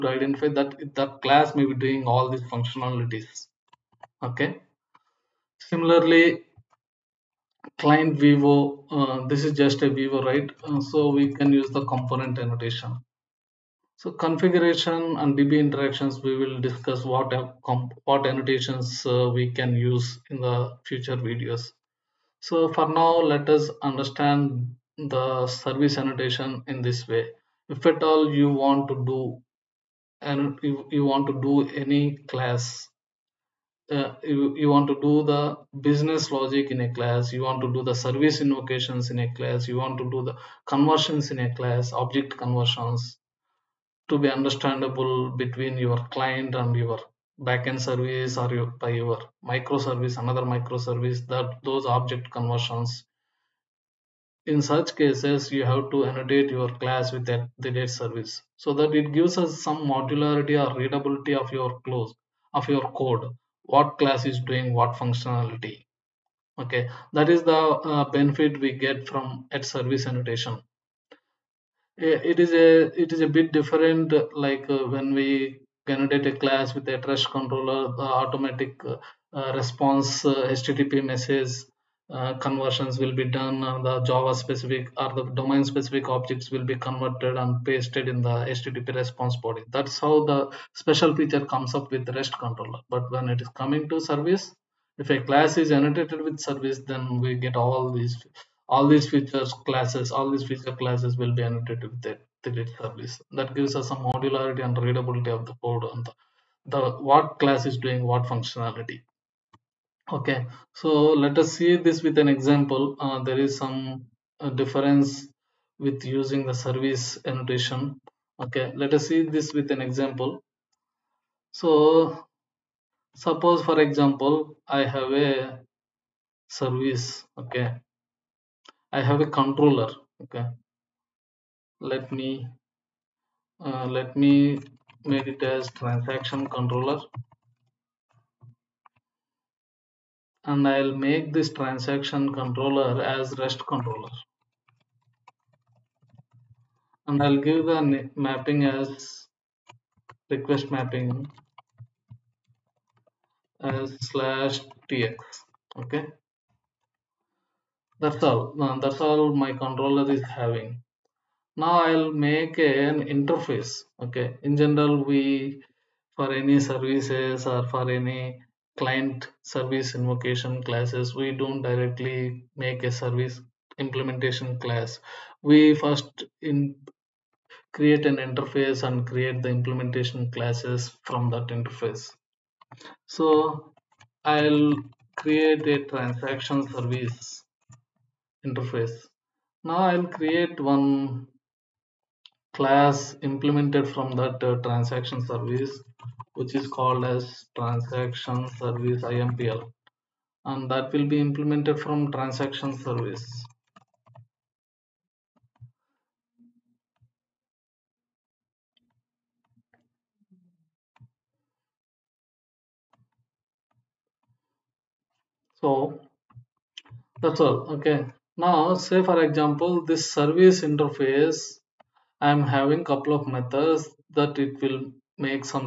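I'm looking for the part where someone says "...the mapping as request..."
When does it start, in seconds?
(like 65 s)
147 s.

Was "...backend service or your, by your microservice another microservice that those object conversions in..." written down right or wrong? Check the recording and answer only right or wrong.
right.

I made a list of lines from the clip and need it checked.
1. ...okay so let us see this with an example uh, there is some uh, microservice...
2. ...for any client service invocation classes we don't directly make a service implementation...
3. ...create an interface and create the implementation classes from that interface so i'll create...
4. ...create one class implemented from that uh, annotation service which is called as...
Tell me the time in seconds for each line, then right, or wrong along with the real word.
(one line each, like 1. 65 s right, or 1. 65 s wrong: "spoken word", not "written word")
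1. 110 s wrong: "difference", not "microservice"
2. 167 s right
3. 177 s right
4. 190 s wrong: "transaction", not "annotation".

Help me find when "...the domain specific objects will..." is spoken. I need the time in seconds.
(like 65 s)
85 s.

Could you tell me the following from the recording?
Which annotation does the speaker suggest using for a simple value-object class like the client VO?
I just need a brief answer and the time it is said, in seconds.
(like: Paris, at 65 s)
Component, at 11 s.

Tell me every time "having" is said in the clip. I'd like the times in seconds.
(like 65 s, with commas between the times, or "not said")
160 s, 222 s.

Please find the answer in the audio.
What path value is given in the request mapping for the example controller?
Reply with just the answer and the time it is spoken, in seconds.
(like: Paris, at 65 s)
/tx, at 154 s.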